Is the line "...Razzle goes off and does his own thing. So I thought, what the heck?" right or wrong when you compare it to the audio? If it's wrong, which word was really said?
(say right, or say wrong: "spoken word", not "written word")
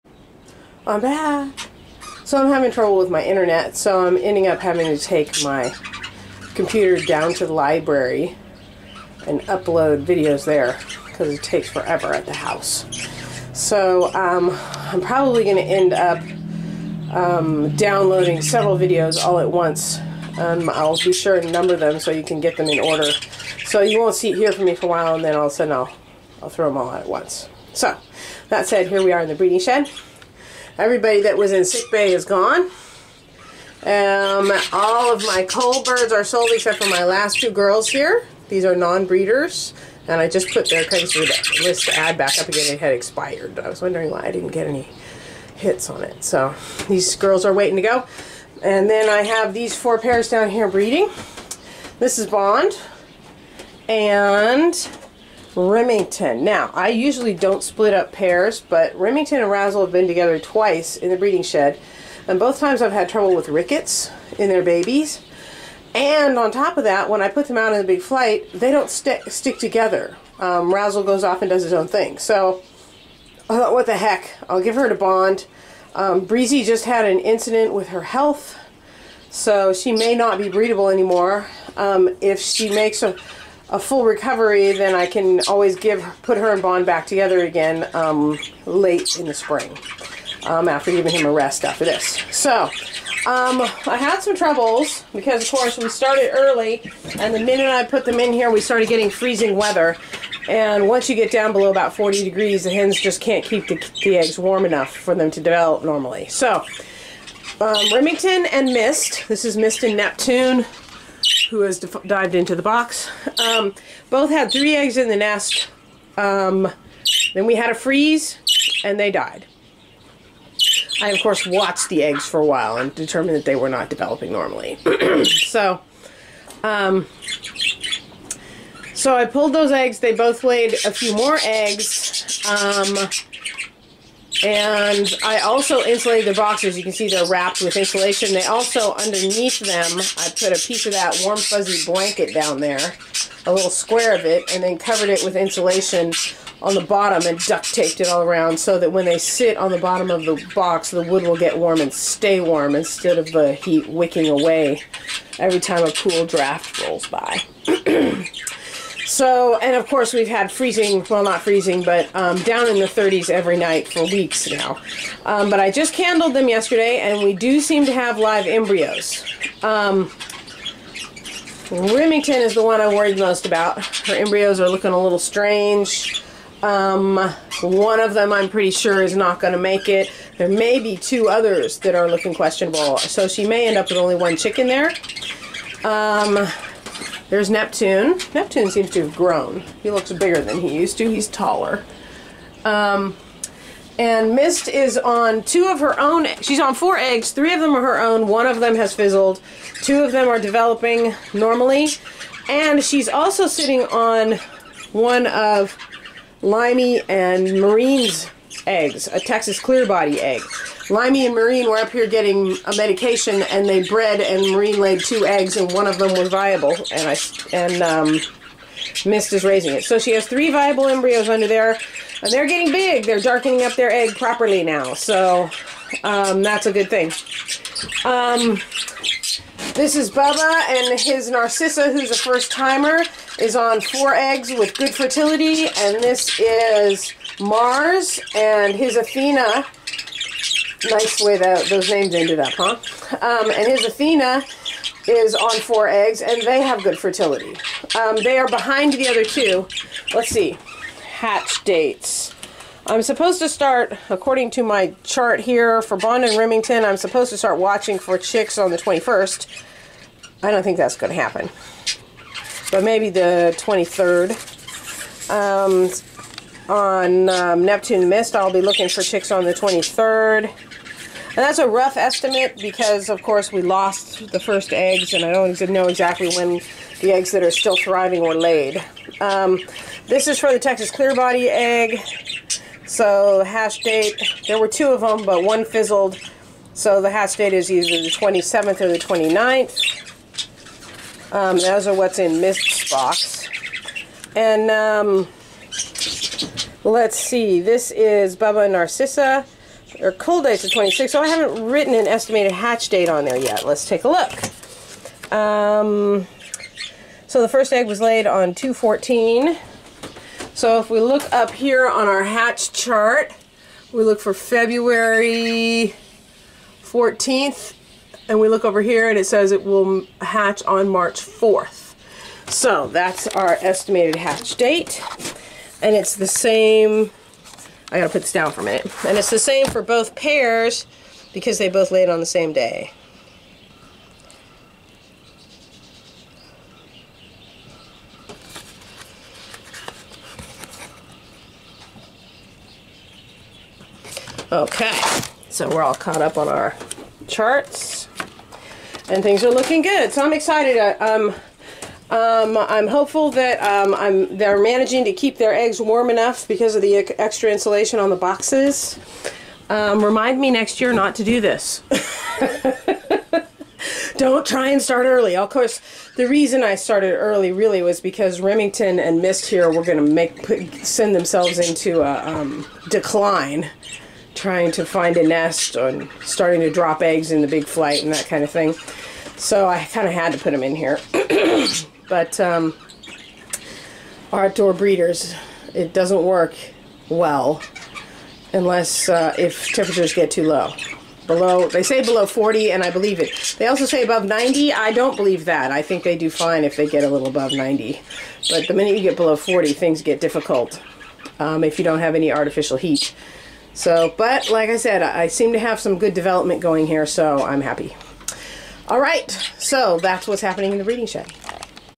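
right.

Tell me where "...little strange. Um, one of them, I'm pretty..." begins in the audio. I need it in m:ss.
2:55.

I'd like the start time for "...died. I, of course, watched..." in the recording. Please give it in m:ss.
1:59.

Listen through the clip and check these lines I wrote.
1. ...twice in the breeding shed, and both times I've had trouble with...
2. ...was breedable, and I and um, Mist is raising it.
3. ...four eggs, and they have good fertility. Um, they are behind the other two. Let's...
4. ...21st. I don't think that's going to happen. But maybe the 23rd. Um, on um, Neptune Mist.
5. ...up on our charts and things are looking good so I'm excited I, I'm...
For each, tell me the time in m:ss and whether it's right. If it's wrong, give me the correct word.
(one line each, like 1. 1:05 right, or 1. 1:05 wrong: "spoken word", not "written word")
1. 1:00 right
2. 3:36 wrong: "viable", not "breedable"
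3. 4:05 right
4. 4:18 right
5. 5:46 right.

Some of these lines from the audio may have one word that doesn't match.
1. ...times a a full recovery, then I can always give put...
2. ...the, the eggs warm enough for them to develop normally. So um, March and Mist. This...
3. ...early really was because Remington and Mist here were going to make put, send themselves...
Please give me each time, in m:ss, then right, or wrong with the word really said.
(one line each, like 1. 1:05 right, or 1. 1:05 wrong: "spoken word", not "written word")
1. 1:22 wrong: "makes", not "times"
2. 1:43 wrong: "Remington", not "March"
3. 6:07 right.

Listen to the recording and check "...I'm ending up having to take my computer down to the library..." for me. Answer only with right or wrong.
right.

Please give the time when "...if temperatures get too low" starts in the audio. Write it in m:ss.
6:29.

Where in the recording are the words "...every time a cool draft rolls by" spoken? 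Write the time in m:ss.
2:35.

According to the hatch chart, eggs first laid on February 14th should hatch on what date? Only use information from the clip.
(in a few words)
March 4th.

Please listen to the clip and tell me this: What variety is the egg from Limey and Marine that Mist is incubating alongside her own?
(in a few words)
Texas clear body.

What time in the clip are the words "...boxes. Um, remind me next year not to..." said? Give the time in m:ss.
5:58.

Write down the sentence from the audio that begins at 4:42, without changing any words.
So hash date, there were two of them, but one fizzled.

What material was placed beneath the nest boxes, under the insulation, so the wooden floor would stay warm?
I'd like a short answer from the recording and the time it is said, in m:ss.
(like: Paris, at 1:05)
warm fuzzy blanket, at 2:21.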